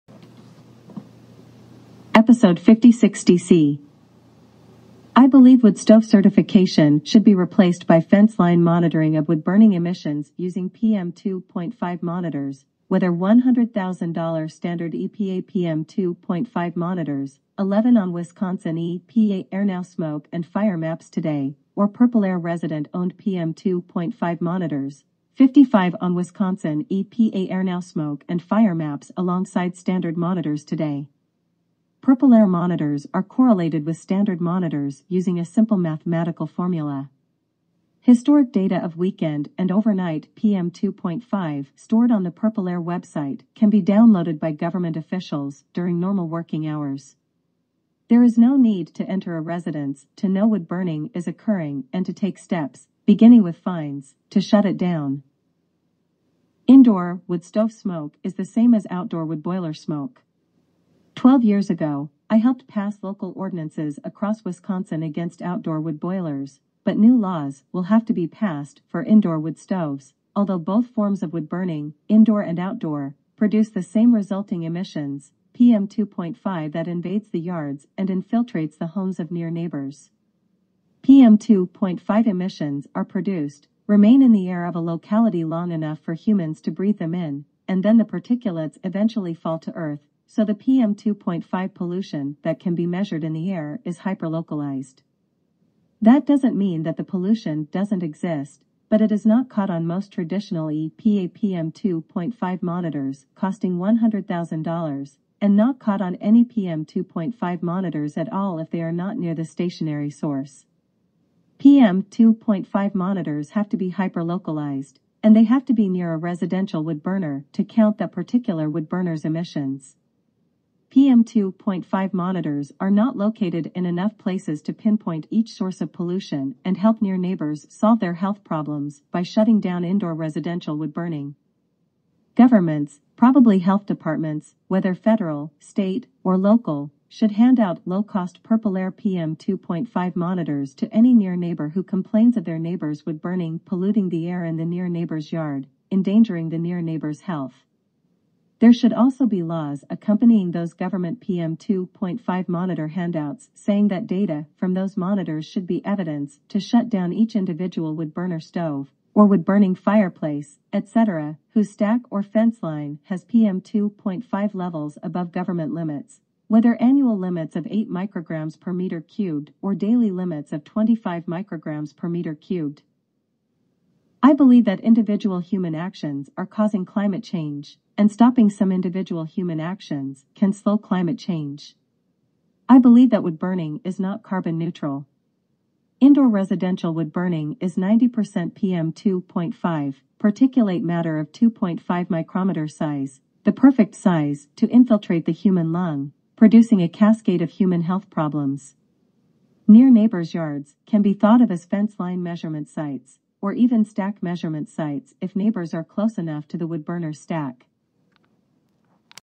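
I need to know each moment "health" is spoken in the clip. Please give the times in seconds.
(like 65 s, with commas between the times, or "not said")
128 s, 133 s, 147 s, 197 s.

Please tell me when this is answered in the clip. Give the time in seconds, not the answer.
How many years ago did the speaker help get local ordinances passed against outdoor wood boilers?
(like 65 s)
61 s.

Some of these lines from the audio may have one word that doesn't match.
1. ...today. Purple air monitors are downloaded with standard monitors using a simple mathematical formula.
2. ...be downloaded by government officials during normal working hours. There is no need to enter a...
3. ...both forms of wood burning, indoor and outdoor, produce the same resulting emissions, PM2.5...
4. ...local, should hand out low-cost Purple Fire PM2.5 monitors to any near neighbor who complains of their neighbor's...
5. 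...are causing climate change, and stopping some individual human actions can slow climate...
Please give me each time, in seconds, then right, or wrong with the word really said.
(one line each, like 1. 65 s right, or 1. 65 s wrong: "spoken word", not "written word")
1. 30 s wrong: "correlated", not "downloaded"
2. 43 s right
3. 70 s right
4. 136 s wrong: "Air", not "Fire"
5. 176 s right.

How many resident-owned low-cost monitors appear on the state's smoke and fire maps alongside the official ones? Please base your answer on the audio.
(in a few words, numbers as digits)
55.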